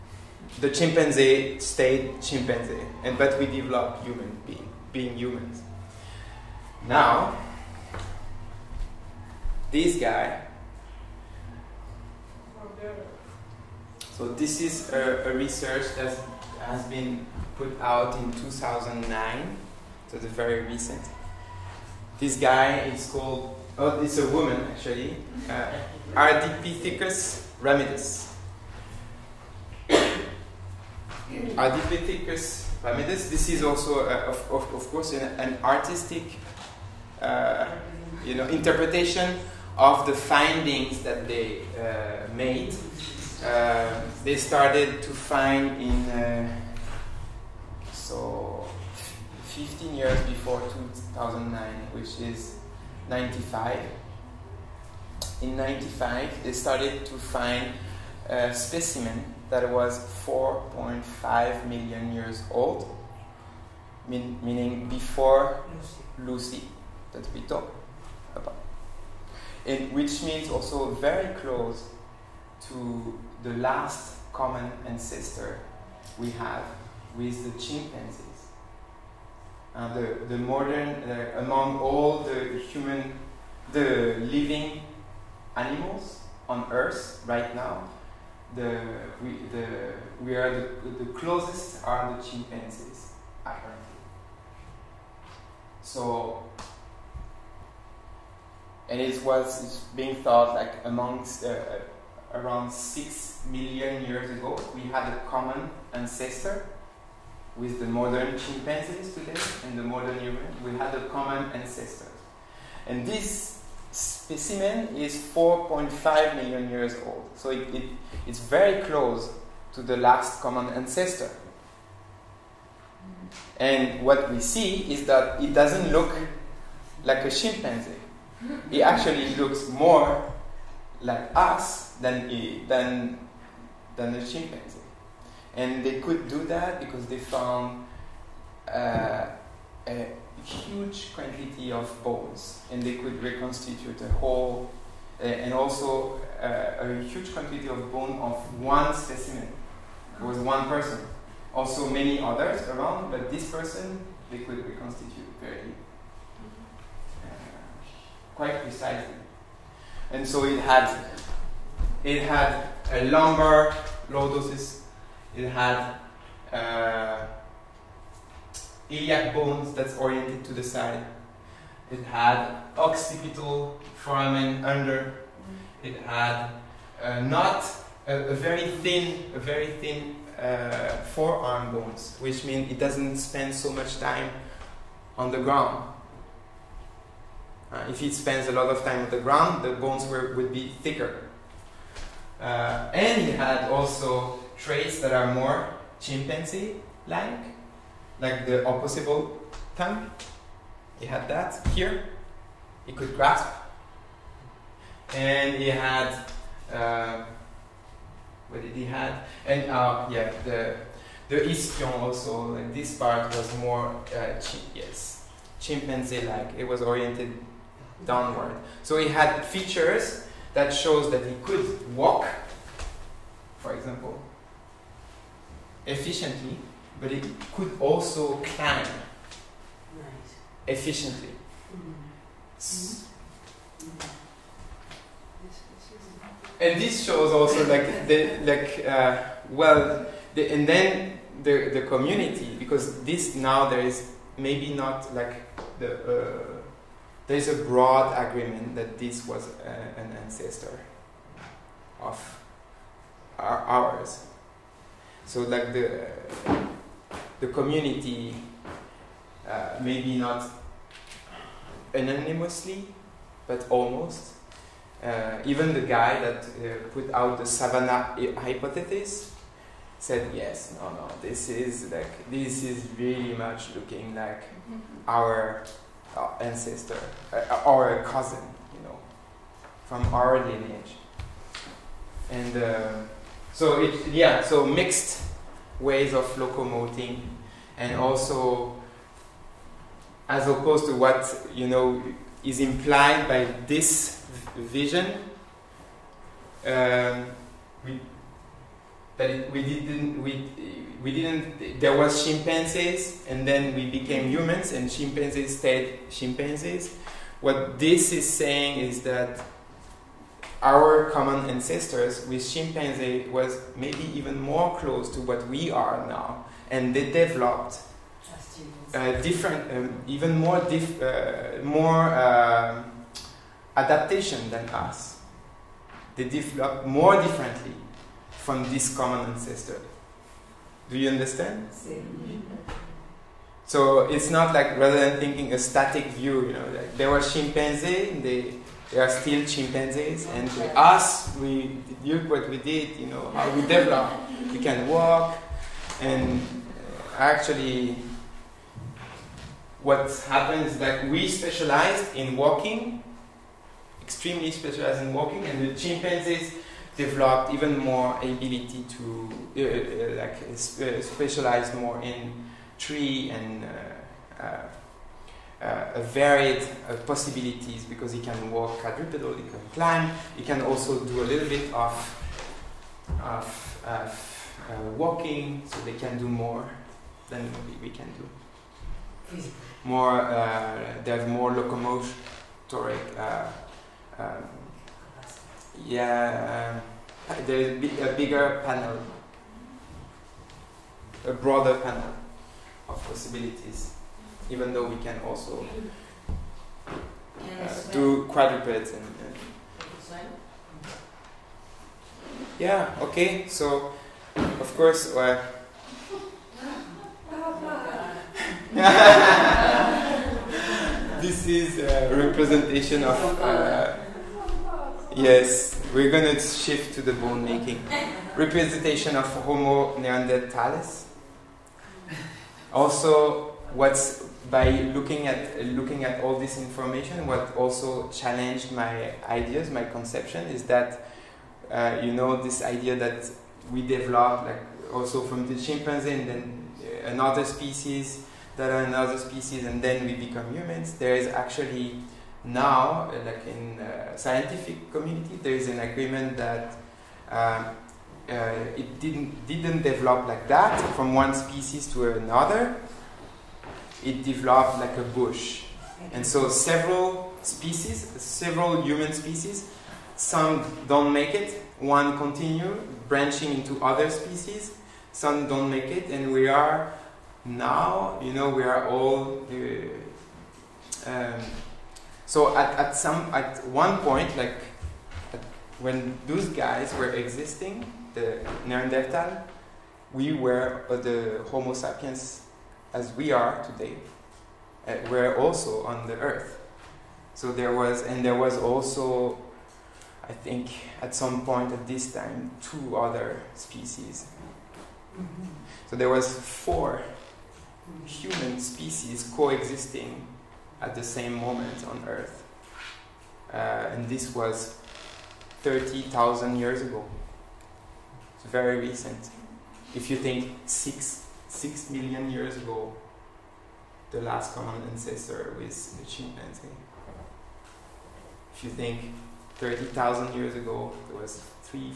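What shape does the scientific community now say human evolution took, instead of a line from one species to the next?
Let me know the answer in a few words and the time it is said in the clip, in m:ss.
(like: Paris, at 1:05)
a bush, at 7:34.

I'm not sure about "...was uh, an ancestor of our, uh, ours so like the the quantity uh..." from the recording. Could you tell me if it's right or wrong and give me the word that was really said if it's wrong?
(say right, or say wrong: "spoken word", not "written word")
wrong: "community", not "quantity".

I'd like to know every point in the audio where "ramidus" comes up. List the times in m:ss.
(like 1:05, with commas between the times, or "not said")
0:27, 0:32.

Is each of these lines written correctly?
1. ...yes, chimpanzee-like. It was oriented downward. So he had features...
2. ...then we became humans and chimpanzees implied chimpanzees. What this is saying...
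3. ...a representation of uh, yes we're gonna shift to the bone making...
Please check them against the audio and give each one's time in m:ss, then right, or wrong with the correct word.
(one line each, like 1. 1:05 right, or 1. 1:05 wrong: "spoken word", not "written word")
1. 3:34 right
2. 5:03 wrong: "stayed", not "implied"
3. 6:51 right.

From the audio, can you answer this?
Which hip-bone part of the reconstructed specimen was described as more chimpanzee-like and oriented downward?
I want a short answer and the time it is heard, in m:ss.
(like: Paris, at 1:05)
ischion, at 3:31.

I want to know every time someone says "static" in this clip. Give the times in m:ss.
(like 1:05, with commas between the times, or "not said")
5:35.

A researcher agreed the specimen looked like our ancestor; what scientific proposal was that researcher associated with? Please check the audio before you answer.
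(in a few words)
savannah hypothesis.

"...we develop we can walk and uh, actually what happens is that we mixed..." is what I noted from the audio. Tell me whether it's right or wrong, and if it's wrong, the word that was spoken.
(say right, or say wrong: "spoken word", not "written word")
wrong: "specialized", not "mixed".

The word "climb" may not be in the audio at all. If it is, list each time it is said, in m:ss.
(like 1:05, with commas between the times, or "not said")
3:48, 6:09.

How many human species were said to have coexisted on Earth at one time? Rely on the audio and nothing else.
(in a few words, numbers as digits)
4.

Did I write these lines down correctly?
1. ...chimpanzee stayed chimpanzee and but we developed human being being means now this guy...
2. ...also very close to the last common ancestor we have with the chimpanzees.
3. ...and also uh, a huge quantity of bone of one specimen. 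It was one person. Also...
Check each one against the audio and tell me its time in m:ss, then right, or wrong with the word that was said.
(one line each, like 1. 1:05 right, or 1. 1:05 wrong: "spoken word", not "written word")
1. 0:00 wrong: "humans", not "means"
2. 1:10 right
3. 2:25 right.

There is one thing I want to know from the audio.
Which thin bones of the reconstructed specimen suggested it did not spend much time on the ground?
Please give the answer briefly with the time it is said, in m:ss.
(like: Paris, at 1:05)
forearm bones, at 3:01.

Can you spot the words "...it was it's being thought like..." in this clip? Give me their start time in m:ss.
1:39.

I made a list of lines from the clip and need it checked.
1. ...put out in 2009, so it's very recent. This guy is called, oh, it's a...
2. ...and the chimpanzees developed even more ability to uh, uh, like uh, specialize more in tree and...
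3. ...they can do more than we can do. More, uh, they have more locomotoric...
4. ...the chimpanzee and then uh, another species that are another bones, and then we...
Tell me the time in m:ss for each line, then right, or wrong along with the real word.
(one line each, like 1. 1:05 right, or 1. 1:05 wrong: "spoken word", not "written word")
1. 0:17 right
2. 5:55 right
3. 6:15 right
4. 7:15 wrong: "species", not "bones".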